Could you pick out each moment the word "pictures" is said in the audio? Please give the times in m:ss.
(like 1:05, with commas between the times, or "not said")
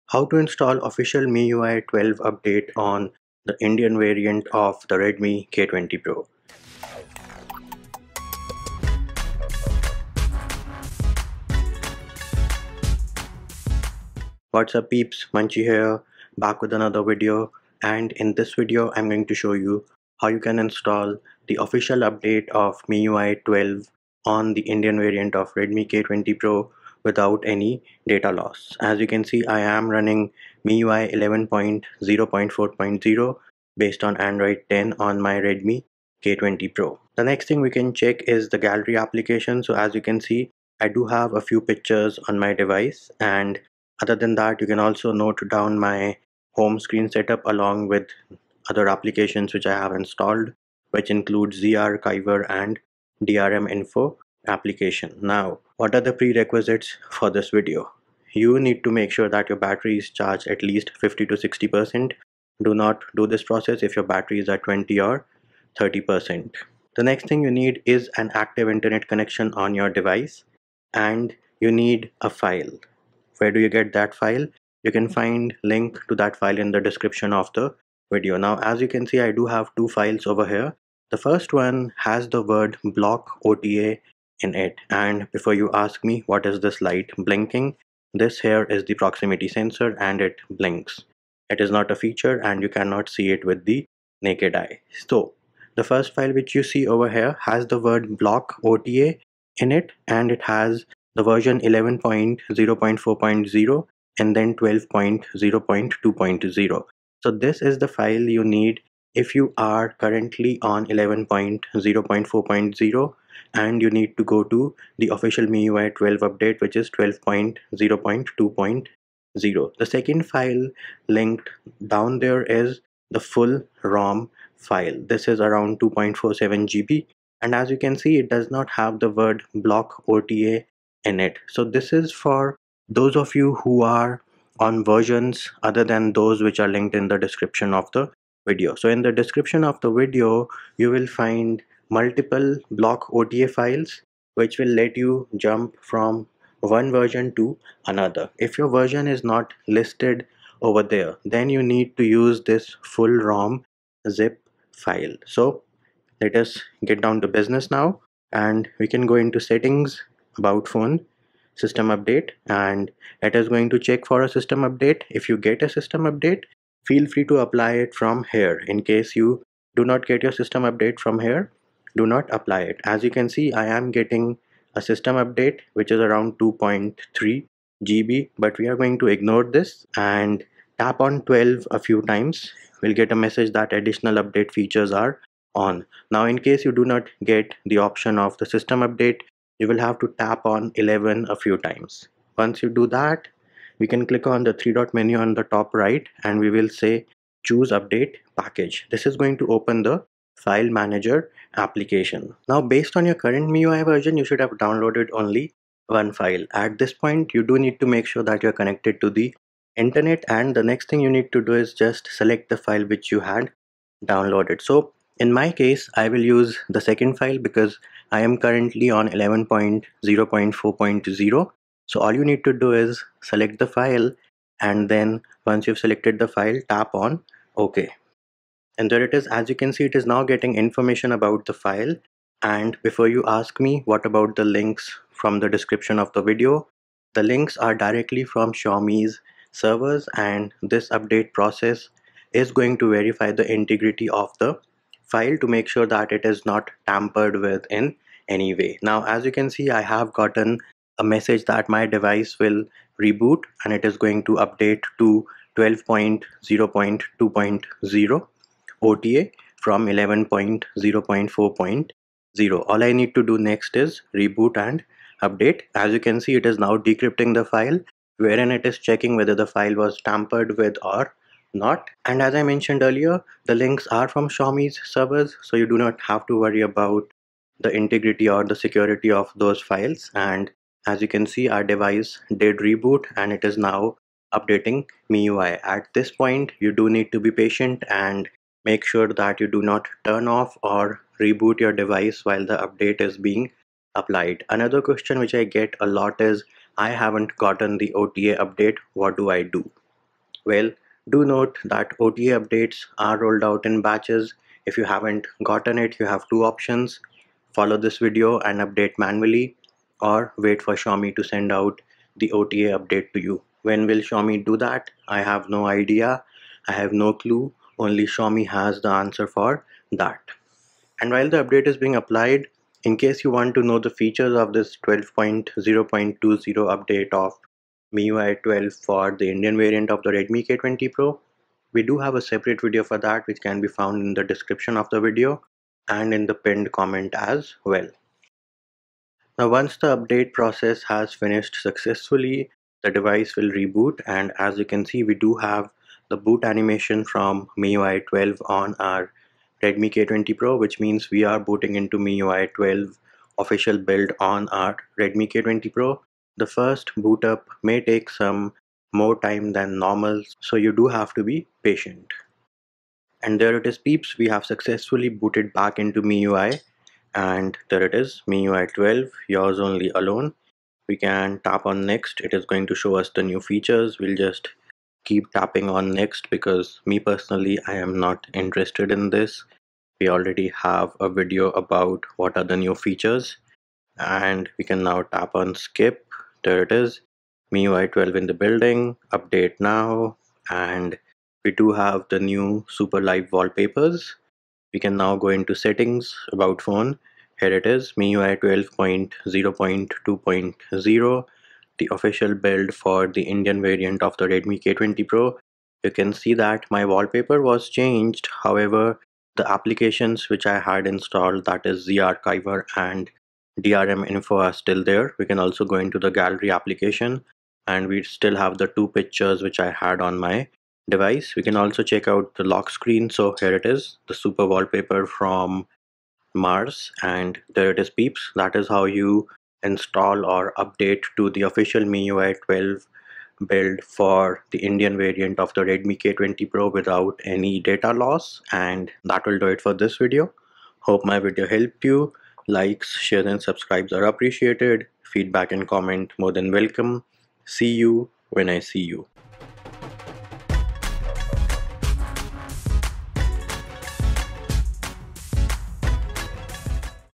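0:41, 6:58.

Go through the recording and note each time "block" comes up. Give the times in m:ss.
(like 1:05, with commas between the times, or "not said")
1:22, 1:38, 2:09, 2:22.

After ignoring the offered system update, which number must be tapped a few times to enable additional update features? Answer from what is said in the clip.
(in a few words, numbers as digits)
12.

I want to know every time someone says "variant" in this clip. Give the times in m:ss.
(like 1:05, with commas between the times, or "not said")
0:03, 0:24, 5:29, 6:43, 7:14.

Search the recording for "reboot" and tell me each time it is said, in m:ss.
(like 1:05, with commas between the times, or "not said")
4:13, 4:24, 4:42, 4:51, 5:43.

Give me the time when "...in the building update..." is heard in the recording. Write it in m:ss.
6:28.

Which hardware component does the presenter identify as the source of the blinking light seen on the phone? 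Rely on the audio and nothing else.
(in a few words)
proximity sensor.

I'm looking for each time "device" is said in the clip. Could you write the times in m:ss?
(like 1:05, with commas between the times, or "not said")
0:42, 1:09, 4:11, 4:41, 4:51, 5:42, 7:00.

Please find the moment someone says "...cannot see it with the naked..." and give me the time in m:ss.
1:32.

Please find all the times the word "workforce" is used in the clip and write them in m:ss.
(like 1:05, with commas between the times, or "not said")
not said.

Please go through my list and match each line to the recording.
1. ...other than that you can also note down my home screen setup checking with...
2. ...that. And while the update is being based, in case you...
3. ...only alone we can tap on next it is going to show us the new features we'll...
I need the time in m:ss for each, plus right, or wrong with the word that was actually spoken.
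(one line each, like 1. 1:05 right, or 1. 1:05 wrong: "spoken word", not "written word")
1. 0:44 wrong: "along", not "checking"
2. 5:19 wrong: "applied", not "based"
3. 6:09 right.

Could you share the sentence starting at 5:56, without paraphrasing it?
The first boot up may take some more time than normal so you do have to be patient.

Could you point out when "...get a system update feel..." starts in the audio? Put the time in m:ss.
2:45.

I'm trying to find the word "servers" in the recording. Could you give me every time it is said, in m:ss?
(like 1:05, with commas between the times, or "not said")
3:59, 4:34.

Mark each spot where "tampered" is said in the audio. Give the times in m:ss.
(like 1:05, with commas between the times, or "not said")
4:06, 4:30.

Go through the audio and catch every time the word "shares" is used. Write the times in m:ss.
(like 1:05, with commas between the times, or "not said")
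7:22.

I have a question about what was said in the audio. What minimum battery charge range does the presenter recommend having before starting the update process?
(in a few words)
50 to 60%.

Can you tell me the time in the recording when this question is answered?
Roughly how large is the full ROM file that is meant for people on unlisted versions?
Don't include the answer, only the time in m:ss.
2:05.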